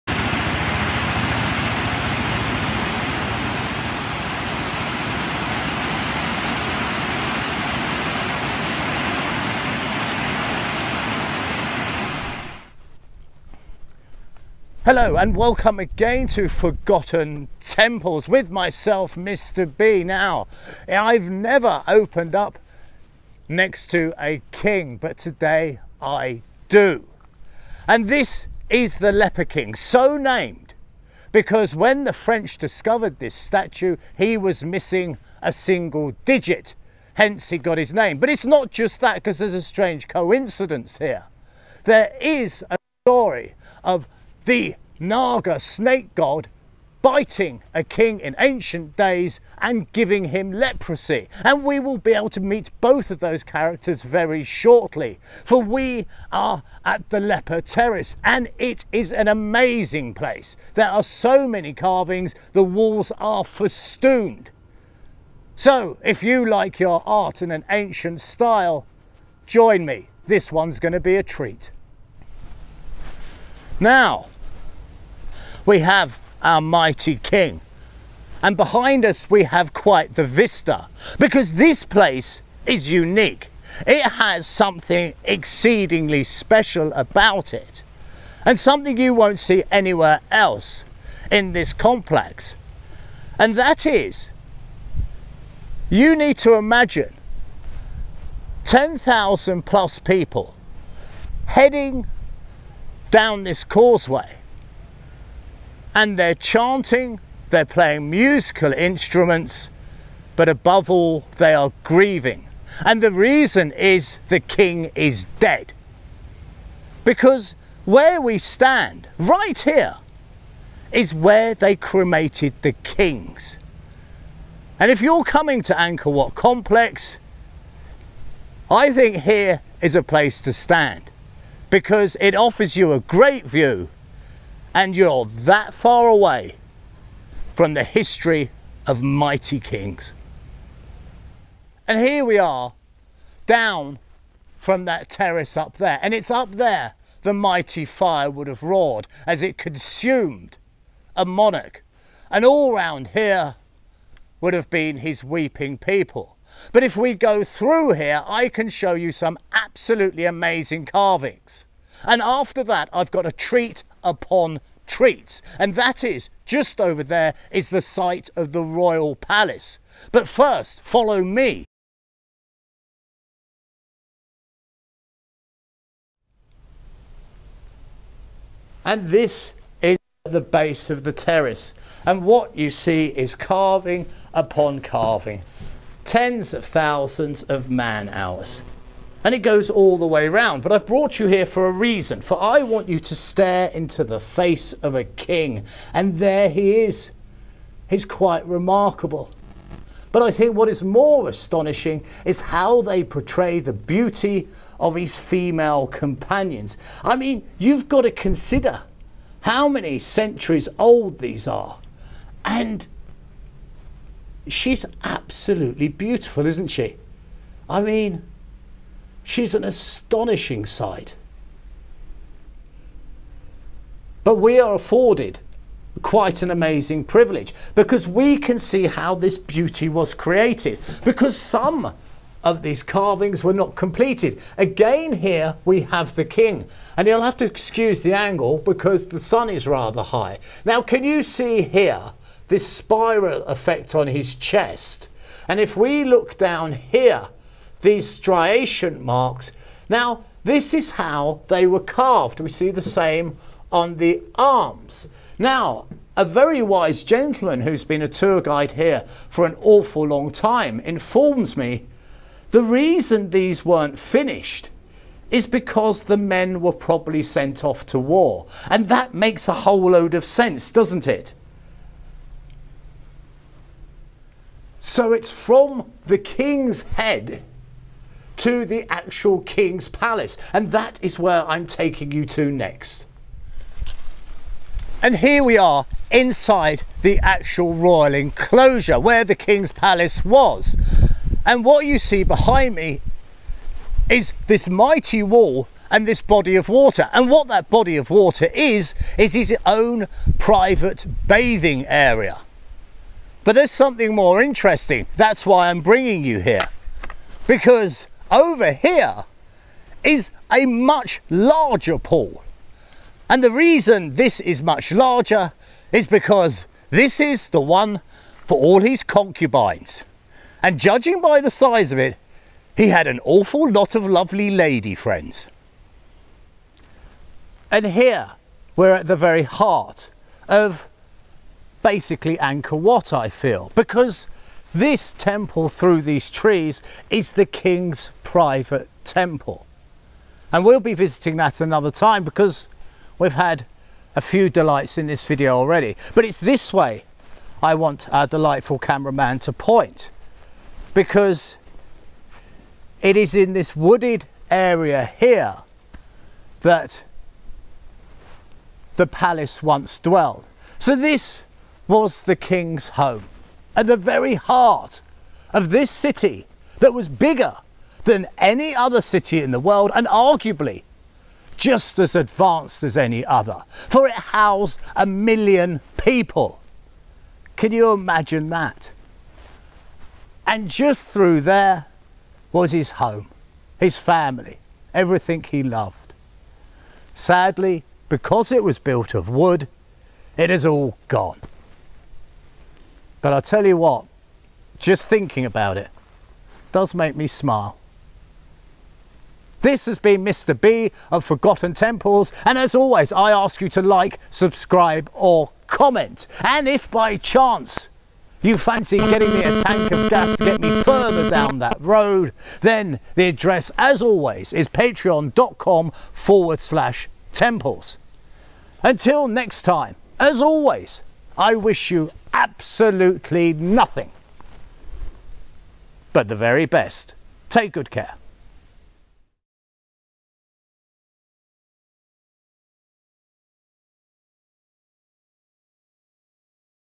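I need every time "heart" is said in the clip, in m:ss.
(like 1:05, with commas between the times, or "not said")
5:29, 6:04.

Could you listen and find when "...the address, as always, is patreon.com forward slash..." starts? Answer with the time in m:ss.
6:53.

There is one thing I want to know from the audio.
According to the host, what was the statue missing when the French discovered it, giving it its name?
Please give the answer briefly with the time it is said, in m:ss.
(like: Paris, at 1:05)
a single digit, at 0:35.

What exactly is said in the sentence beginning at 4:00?
Now can you see here this spiral effect on his chest and if we look down here these striation marks.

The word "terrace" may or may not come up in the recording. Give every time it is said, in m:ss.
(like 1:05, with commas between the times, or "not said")
0:57, 2:25, 3:01.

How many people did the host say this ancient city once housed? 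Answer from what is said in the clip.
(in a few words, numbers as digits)
1,000,000.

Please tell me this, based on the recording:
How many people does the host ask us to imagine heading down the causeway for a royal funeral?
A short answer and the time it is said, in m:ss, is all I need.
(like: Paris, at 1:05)
10,000 plus, at 1:38.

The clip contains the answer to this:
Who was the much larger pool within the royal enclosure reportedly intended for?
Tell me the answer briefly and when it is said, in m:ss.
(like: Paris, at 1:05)
his concubines, at 5:18.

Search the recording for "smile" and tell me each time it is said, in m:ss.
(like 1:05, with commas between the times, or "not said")
6:37.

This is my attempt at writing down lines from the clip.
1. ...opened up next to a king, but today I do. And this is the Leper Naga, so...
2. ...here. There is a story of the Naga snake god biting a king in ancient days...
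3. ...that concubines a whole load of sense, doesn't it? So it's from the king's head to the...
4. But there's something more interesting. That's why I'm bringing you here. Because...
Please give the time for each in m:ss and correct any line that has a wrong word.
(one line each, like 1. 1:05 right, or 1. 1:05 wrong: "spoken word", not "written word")
1. 0:21 wrong: "King", not "Naga"
2. 0:40 right
3. 4:28 wrong: "makes", not "concubines"
4. 5:03 right.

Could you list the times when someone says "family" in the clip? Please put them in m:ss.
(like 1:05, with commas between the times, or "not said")
6:23.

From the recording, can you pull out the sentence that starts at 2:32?
And all round here would have been his weeping people.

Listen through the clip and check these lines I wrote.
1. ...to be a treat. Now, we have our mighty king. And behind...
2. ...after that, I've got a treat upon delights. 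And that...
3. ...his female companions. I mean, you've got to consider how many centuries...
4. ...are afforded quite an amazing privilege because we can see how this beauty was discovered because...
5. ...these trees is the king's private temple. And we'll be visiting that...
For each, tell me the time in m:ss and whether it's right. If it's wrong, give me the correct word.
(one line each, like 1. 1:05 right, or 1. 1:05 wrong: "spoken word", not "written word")
1. 1:10 right
2. 2:42 wrong: "treats", not "delights"
3. 3:24 right
4. 3:44 wrong: "created", not "discovered"
5. 5:36 right.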